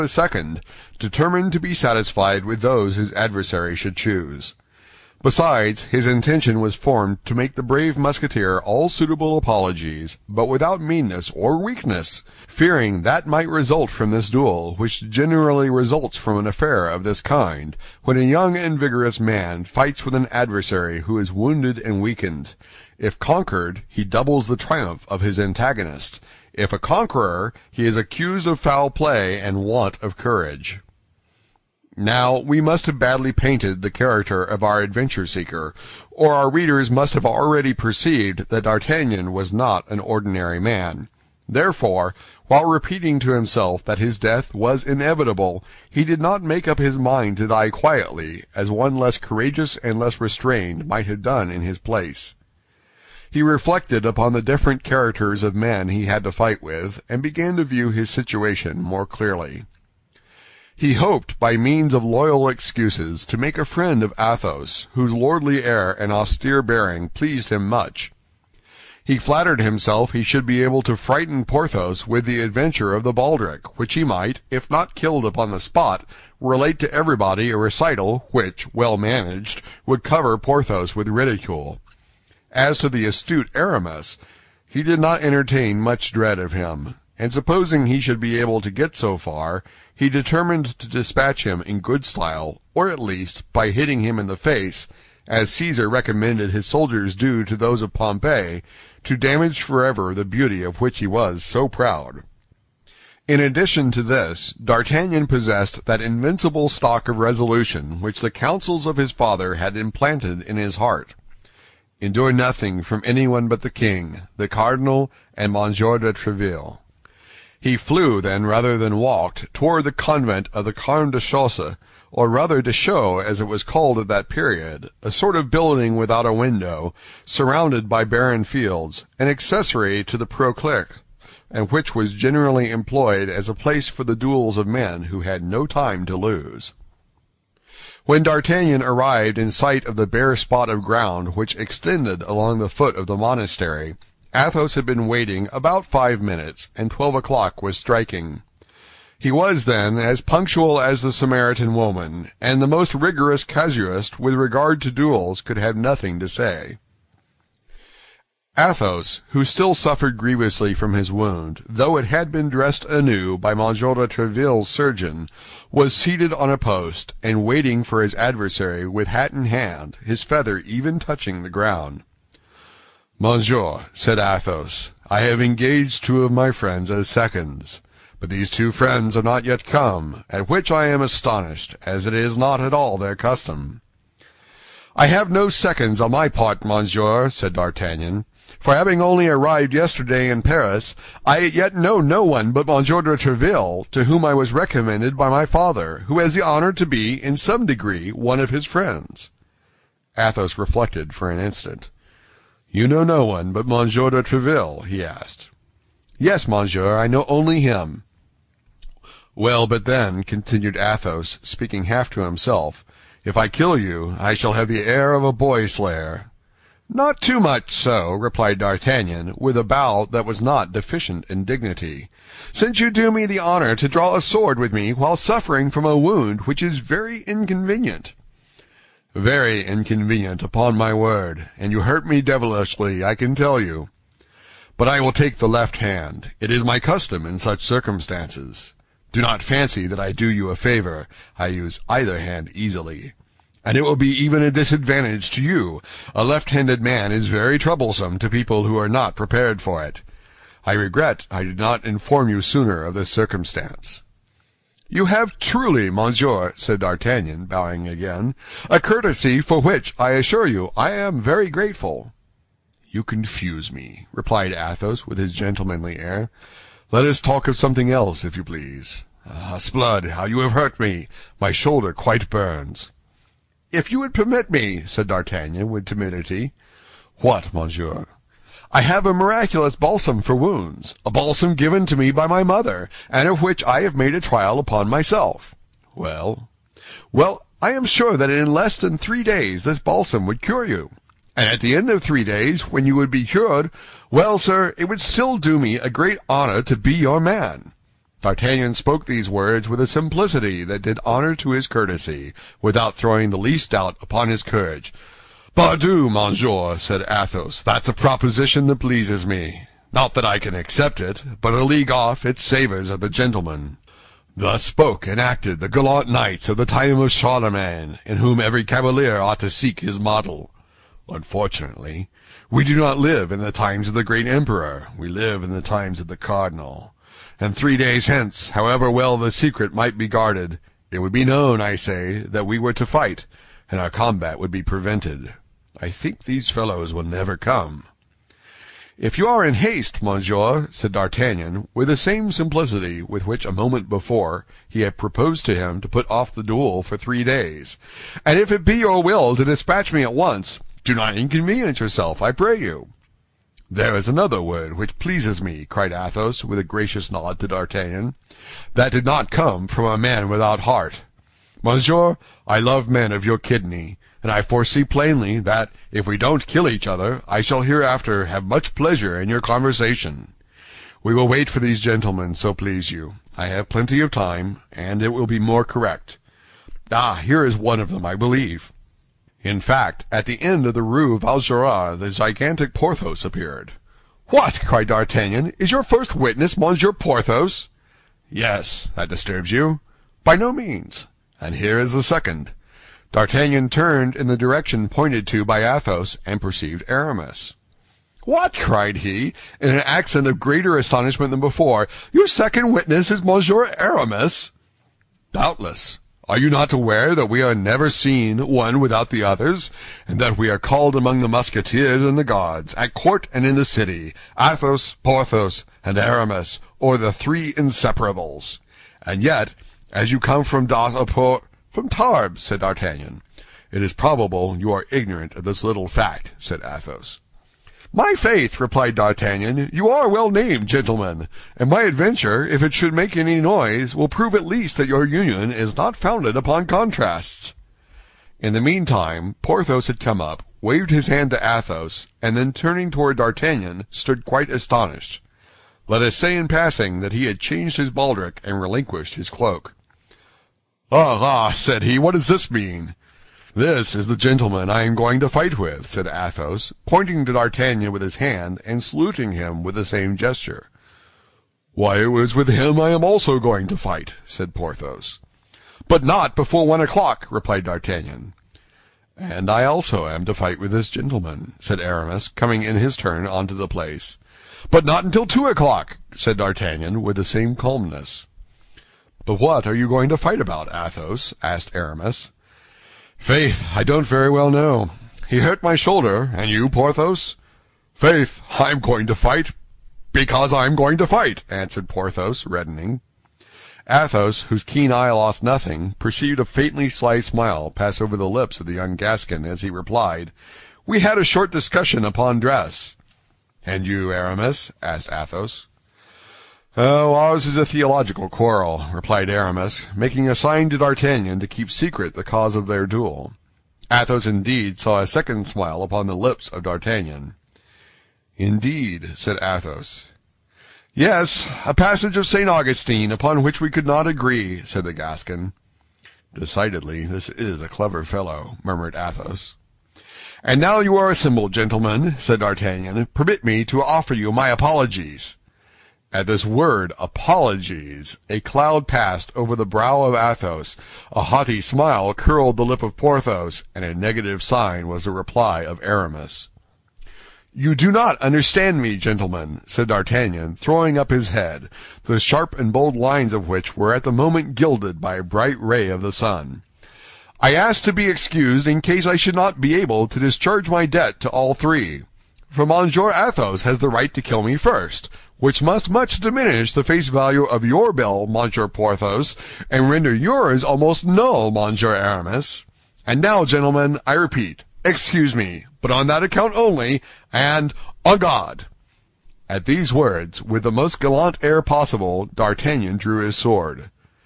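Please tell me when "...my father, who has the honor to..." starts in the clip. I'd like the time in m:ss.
3:15.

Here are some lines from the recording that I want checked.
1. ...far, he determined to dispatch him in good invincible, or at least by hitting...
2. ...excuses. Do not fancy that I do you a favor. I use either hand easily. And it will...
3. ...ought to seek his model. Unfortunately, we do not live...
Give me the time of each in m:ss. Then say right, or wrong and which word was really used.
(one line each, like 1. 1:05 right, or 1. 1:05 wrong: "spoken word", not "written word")
1. 1:29 wrong: "style", not "invincible"
2. 3:57 wrong: "circumstances", not "excuses"
3. 5:19 right.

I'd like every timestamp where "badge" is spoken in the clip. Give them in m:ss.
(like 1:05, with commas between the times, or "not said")
not said.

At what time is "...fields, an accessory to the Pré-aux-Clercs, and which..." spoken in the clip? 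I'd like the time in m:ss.
2:08.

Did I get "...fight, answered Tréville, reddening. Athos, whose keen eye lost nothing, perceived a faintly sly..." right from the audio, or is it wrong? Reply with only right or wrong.
wrong.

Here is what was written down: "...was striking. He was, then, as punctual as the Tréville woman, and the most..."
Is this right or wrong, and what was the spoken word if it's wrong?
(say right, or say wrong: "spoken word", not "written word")
wrong: "Samaritan", not "Tréville".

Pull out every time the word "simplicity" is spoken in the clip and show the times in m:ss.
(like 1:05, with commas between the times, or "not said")
4:59, 5:42.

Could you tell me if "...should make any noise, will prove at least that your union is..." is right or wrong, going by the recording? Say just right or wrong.
right.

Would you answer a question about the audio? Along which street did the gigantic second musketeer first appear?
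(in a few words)
Rue Vaugirard.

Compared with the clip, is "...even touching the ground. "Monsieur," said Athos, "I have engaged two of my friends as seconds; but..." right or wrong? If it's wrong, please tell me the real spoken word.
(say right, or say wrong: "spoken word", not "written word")
right.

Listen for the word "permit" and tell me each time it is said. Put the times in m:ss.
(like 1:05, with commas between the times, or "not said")
4:34, 8:53.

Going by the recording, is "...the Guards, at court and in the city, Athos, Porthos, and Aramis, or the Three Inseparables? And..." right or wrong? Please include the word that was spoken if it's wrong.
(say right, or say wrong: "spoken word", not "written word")
right.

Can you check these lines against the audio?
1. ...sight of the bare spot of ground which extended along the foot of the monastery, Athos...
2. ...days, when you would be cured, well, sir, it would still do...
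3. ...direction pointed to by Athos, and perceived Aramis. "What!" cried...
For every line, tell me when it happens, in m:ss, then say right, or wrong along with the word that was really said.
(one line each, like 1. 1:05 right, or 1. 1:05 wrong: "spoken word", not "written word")
1. 2:19 right
2. 4:52 right
3. 6:34 right.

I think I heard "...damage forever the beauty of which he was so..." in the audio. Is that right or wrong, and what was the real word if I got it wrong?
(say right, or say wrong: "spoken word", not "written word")
right.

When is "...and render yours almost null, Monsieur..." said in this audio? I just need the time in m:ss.
9:29.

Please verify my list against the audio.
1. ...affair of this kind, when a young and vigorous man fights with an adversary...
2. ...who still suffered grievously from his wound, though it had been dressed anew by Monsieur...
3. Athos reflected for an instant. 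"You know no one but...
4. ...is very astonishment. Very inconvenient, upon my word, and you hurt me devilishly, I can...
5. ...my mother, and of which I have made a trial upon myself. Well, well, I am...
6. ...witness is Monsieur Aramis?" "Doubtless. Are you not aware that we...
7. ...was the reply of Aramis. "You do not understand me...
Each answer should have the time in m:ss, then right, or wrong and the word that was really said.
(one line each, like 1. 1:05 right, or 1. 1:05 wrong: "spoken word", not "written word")
1. 0:16 right
2. 2:39 right
3. 3:20 right
4. 3:46 wrong: "inconvenient", not "astonishment"
5. 4:42 right
6. 6:42 right
7. 9:04 right.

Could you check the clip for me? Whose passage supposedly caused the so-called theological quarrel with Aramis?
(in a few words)
St. Augustine.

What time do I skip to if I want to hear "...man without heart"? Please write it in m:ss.
5:59.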